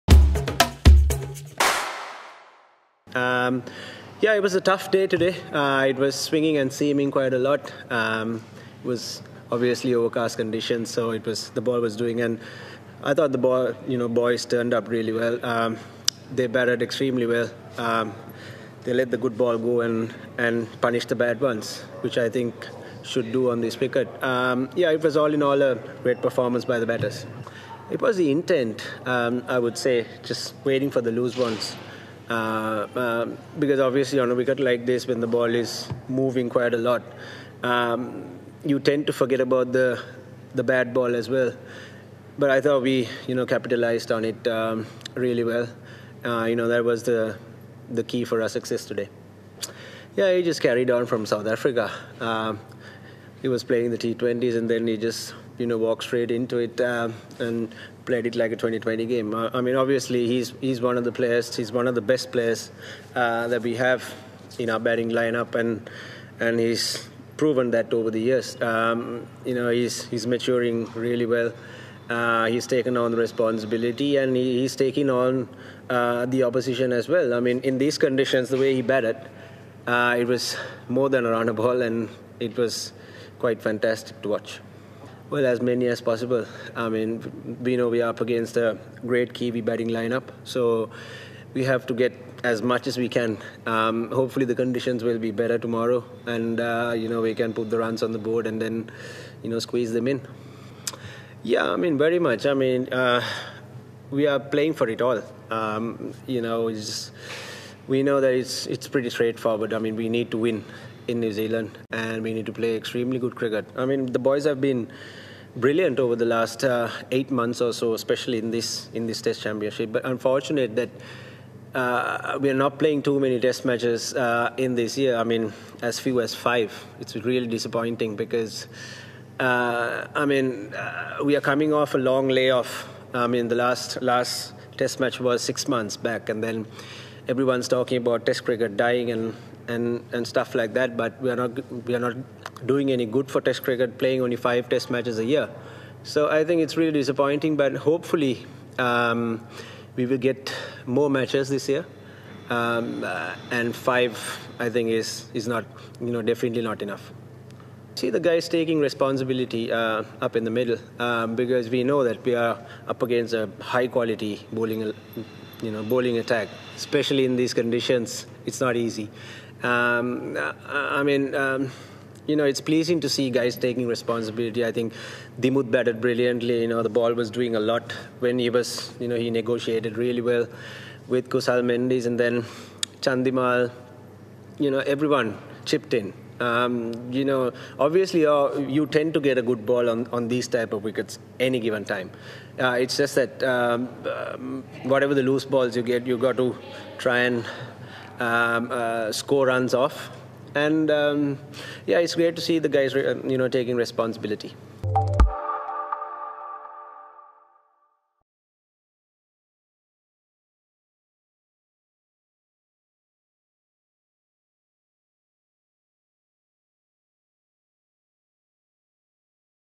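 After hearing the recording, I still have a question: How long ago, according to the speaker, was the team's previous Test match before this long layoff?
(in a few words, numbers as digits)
6 months.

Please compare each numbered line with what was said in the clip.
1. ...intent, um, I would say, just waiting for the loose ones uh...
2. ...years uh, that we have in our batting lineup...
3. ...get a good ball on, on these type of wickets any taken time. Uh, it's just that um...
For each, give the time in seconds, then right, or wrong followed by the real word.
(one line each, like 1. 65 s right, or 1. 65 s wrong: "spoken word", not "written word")
1. 28 s right
2. 62 s wrong: "players", not "years"
3. 189 s wrong: "given", not "taken".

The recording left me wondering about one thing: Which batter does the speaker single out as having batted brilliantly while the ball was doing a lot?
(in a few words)
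Dimuth.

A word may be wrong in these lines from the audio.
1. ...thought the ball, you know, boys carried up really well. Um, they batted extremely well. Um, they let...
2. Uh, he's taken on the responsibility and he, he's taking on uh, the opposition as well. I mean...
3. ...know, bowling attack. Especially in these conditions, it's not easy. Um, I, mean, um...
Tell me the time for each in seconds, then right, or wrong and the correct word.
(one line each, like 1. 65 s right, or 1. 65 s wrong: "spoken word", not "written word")
1. 13 s wrong: "turned", not "carried"
2. 72 s right
3. 165 s right.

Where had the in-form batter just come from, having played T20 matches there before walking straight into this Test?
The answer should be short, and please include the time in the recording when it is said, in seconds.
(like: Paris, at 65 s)
South Africa, at 51 s.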